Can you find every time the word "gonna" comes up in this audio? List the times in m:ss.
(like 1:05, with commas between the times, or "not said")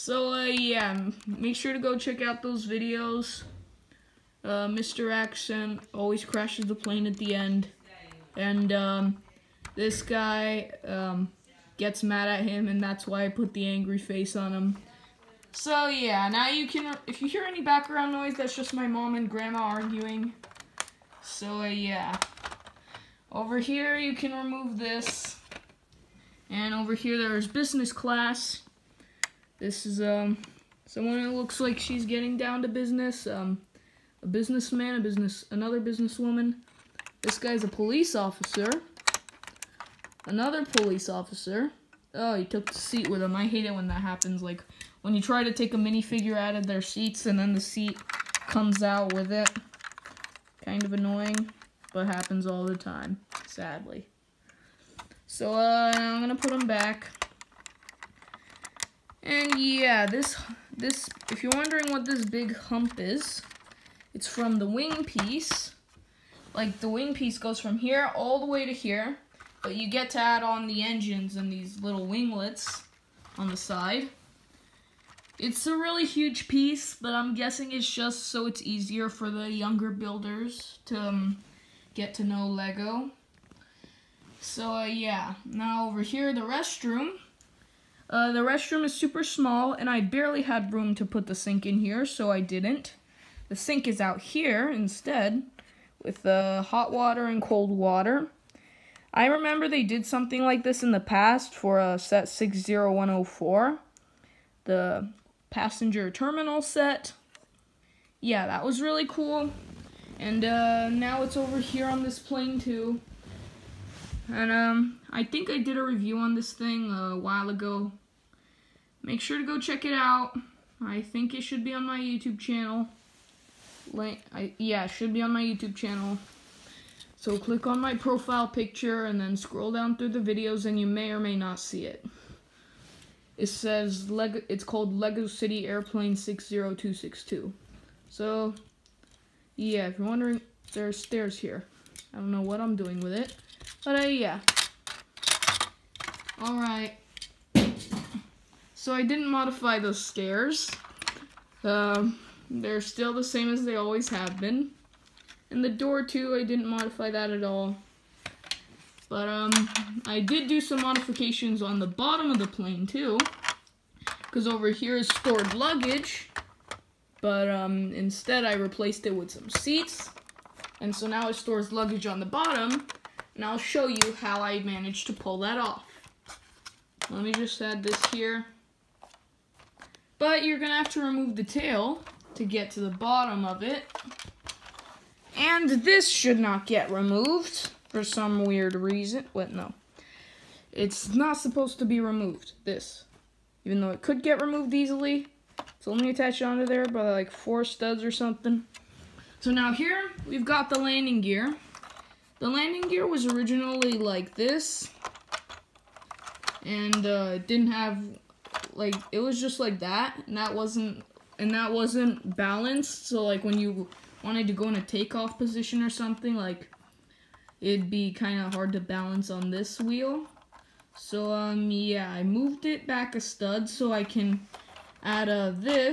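0:56, 3:00.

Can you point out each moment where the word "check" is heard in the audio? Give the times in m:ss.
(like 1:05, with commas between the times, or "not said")
0:01, 1:59.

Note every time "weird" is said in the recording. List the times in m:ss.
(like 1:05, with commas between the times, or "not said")
3:08.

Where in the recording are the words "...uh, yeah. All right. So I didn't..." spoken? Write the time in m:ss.
2:24.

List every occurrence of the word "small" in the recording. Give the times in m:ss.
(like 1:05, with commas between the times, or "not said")
1:29.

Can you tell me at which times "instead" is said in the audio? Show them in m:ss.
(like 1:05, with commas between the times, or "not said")
1:34, 2:47.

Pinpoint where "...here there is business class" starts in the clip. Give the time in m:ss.
0:26.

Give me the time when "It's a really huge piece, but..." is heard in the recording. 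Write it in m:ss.
1:15.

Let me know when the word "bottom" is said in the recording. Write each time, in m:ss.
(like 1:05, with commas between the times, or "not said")
2:41, 2:52, 3:02.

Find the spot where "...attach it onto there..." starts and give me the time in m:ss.
3:16.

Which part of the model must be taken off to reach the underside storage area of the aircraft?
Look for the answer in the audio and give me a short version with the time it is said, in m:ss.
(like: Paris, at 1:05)
the tail, at 3:01.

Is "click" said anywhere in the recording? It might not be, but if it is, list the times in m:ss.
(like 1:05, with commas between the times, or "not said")
2:07.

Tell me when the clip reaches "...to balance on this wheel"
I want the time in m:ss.
3:38.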